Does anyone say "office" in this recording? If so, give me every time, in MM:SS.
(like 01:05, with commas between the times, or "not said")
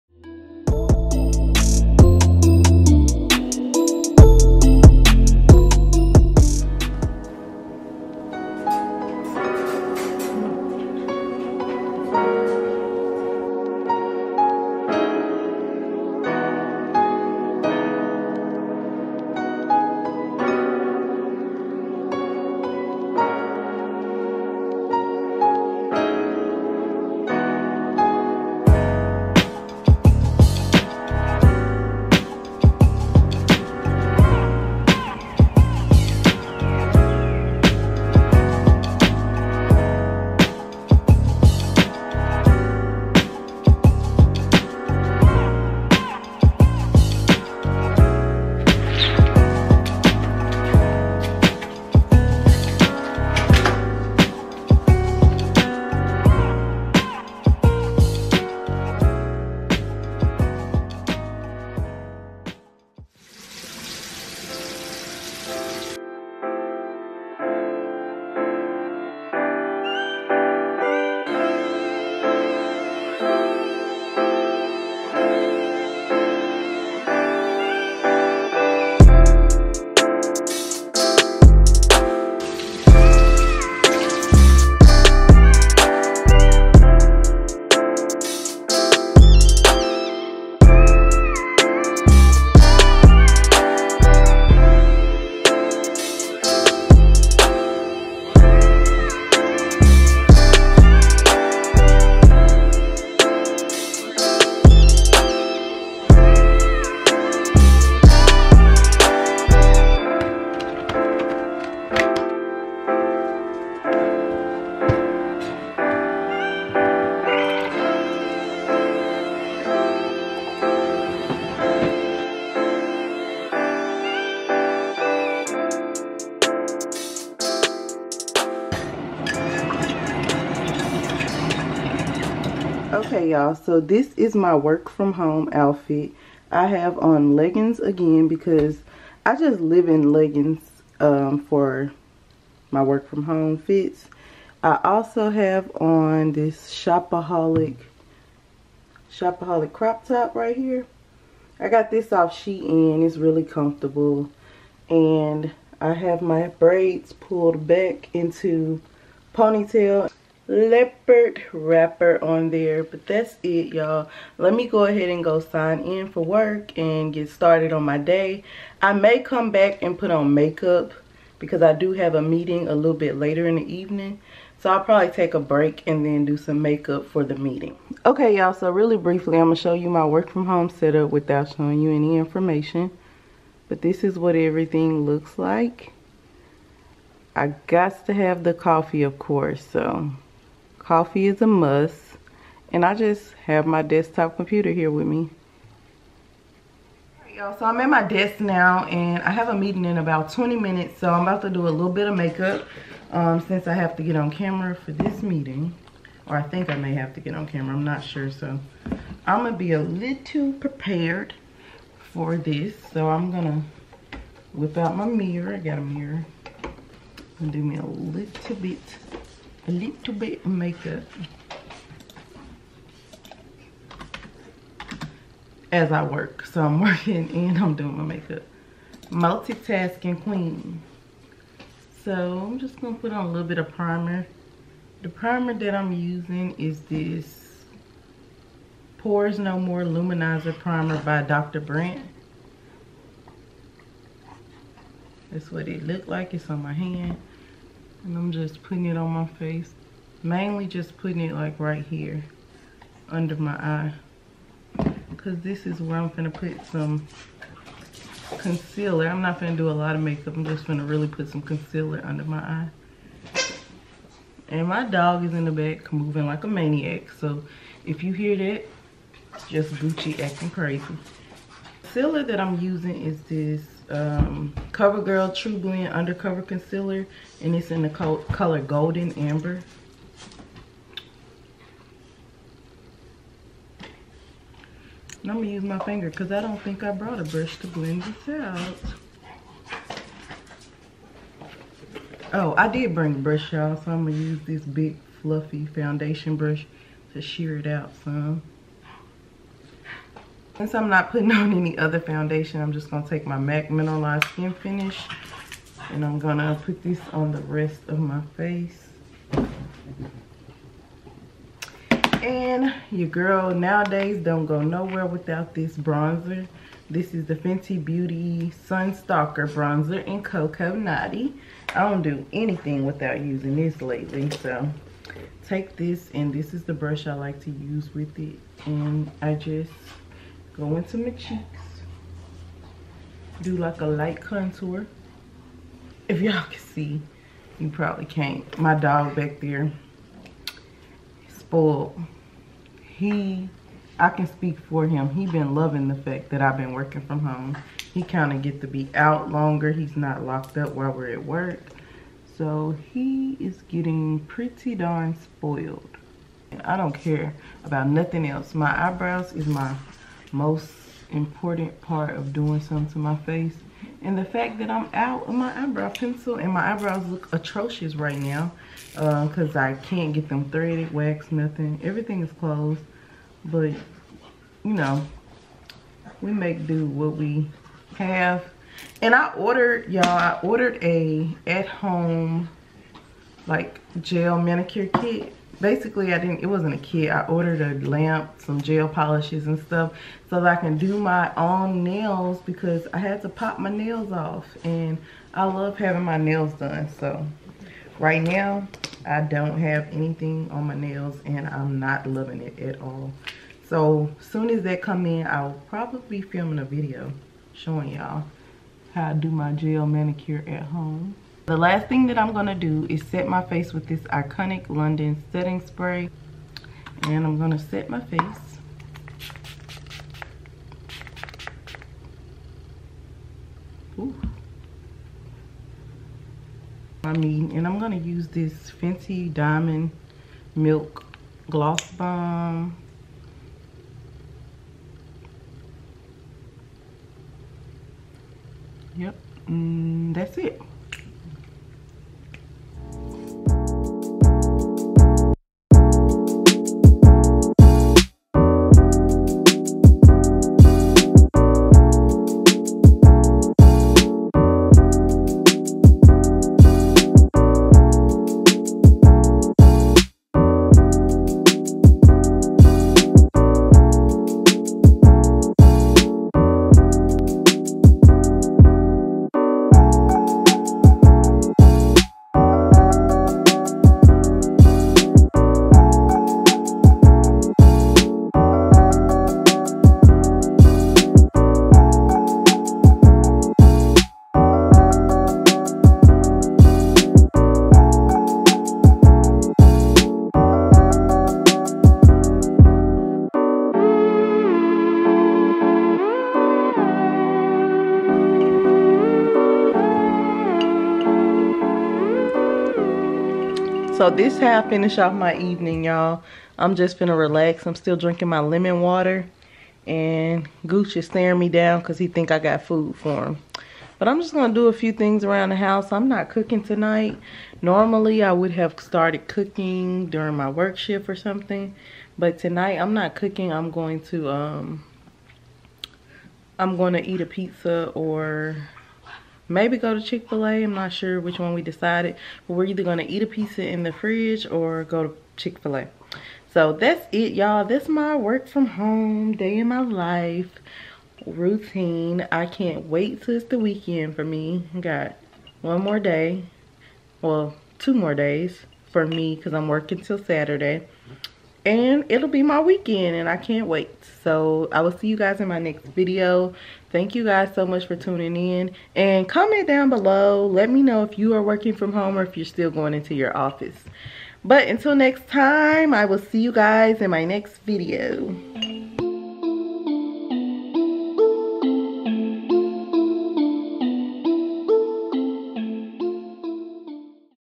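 09:23.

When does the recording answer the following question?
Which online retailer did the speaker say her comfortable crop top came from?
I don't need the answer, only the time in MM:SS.
02:32.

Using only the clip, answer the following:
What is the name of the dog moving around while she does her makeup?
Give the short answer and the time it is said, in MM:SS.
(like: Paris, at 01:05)
Gucci, at 04:29.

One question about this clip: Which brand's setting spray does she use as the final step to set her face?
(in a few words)
Iconic London.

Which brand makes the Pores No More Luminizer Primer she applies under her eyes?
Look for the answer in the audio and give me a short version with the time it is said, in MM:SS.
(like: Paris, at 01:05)
Dr. Brandt, at 04:01.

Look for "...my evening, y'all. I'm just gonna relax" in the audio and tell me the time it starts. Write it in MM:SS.
08:25.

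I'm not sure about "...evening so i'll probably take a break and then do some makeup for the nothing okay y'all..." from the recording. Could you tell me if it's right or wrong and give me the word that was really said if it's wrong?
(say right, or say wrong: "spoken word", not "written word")
wrong: "meeting", not "nothing".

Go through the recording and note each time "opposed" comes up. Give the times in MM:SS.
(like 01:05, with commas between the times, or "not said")
not said.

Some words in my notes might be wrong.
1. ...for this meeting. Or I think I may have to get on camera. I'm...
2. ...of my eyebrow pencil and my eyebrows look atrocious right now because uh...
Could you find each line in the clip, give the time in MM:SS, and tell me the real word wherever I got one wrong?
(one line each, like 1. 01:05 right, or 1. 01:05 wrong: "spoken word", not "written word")
1. 03:24 right
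2. 06:05 right.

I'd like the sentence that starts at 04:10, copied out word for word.
Mainly just putting it like right here under my eye.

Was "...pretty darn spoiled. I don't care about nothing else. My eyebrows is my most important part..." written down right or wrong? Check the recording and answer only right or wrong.
right.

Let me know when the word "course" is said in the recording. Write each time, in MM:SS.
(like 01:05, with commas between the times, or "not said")
03:09.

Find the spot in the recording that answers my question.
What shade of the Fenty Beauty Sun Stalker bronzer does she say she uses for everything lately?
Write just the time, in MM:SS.
05:20.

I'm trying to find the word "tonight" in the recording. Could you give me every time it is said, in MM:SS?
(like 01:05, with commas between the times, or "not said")
08:36, 08:42.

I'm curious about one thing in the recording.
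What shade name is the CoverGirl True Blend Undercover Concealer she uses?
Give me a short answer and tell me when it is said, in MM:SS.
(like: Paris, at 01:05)
Golden Amber, at 04:38.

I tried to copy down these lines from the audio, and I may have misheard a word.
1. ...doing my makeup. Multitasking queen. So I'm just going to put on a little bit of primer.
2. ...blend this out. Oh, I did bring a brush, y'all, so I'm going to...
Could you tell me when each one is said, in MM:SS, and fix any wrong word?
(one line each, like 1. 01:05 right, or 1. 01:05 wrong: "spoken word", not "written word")
1. 03:47 right
2. 04:47 right.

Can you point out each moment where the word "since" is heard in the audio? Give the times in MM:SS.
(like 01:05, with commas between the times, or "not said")
03:23, 05:00.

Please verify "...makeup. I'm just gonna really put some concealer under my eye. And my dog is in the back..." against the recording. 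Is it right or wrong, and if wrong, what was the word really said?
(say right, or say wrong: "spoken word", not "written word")
right.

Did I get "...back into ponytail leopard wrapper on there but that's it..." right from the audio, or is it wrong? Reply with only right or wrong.
right.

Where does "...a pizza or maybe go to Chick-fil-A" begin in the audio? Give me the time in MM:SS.
08:47.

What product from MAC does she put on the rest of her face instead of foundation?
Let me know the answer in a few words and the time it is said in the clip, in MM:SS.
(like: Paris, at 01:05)
Mineralize Skin Finish, at 05:03.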